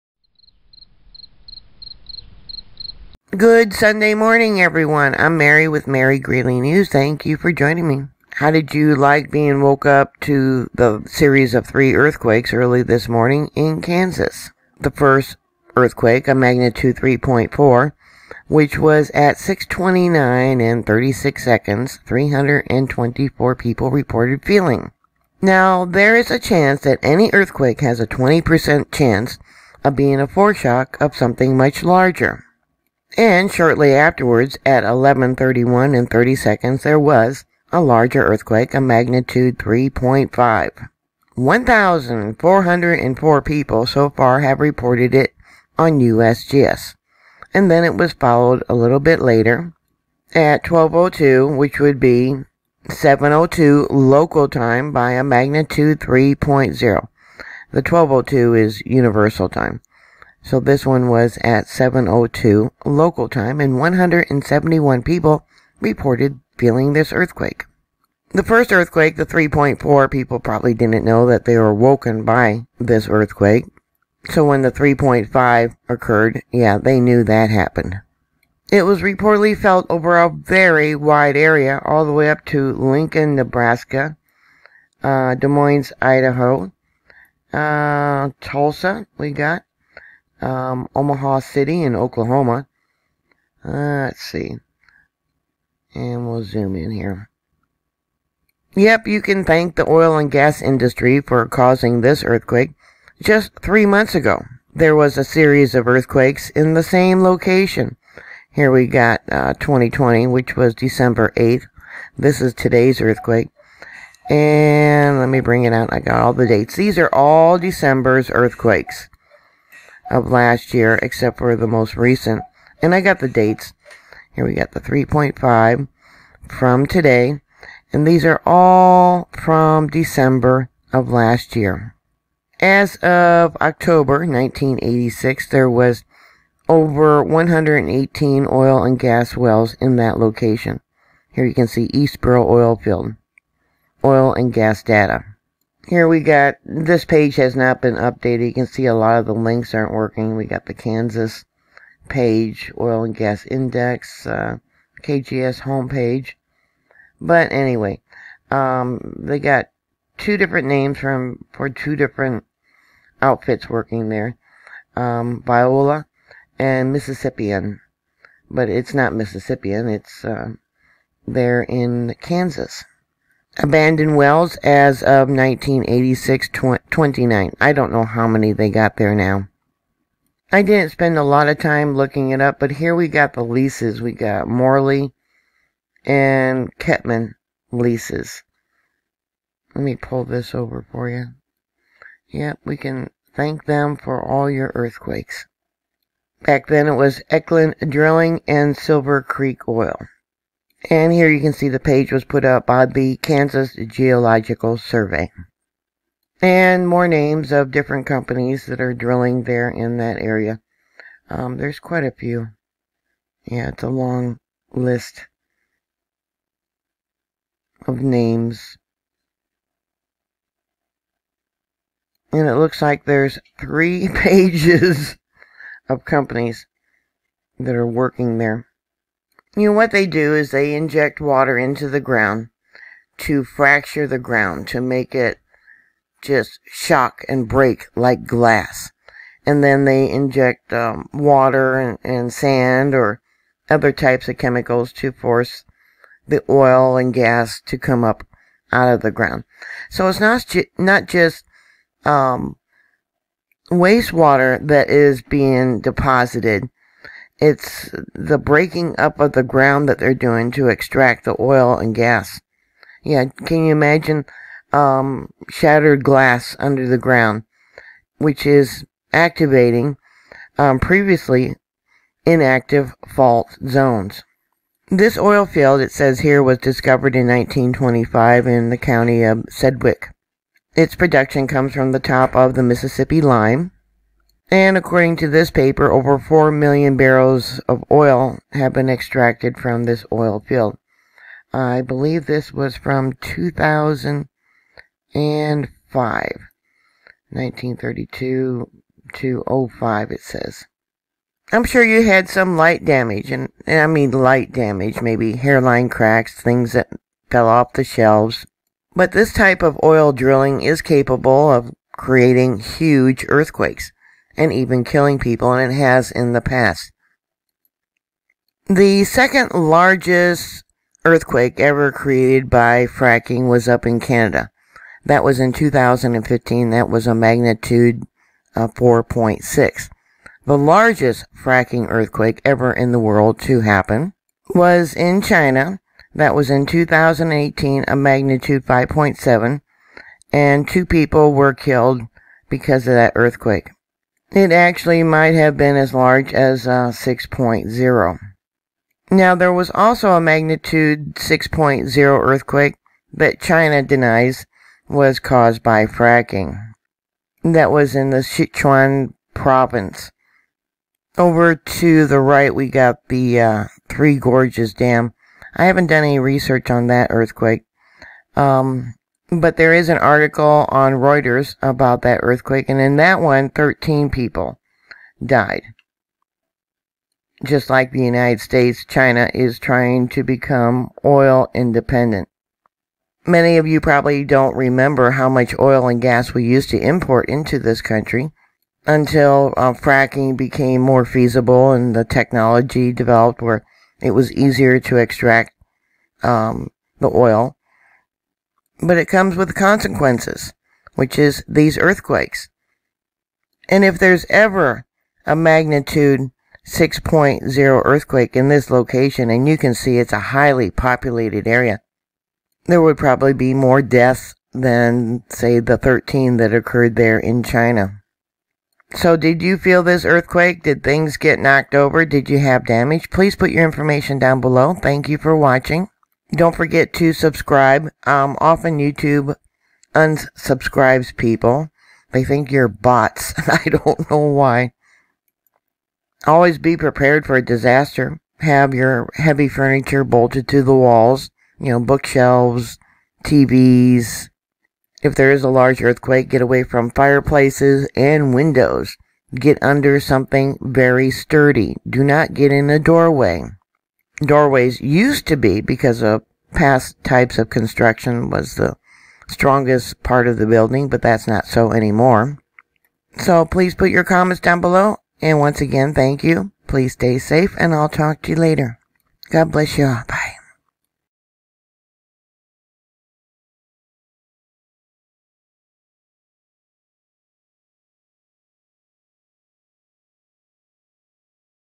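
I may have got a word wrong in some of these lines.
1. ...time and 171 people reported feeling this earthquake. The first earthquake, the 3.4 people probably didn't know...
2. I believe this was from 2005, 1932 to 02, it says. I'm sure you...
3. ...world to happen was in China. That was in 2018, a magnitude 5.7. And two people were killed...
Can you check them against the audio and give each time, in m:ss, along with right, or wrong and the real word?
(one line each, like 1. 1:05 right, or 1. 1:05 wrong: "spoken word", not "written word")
1. 1:03 right
2. 4:51 wrong: "05", not "02"
3. 5:32 right.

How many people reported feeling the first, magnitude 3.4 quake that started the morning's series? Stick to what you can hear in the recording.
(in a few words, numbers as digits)
324.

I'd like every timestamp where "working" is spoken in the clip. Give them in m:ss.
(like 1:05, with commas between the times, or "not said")
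2:29, 2:43, 3:47.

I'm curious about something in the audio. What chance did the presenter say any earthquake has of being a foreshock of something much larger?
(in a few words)
20%.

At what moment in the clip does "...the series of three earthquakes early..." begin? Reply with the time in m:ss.
0:10.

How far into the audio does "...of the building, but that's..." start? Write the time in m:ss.
7:40.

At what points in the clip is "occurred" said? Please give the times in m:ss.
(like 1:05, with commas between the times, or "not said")
1:15, 6:56.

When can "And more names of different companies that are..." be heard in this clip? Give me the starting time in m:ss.
3:26.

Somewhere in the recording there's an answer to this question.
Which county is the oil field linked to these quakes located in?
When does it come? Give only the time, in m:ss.
4:39.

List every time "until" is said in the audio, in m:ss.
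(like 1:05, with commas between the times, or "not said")
6:28.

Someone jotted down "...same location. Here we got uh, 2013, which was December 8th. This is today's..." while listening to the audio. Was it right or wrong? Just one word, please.
wrong.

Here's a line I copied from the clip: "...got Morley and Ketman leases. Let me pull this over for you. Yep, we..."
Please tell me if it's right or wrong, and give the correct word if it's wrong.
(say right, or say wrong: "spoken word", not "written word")
right.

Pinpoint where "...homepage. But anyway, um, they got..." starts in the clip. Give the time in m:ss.
2:35.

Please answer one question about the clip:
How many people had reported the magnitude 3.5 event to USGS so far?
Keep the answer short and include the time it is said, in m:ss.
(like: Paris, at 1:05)
1,404, at 0:41.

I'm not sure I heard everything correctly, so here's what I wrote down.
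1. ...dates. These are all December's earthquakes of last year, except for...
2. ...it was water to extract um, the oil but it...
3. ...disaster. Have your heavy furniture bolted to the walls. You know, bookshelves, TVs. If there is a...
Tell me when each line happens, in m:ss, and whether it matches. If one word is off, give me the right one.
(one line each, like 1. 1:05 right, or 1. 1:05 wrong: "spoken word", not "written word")
1. 1:56 right
2. 6:34 wrong: "easier", not "water"
3. 7:17 right.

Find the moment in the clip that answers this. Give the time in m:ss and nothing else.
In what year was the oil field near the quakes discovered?
4:37.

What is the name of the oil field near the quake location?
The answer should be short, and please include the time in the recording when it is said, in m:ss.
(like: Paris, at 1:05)
Eastborough, at 2:21.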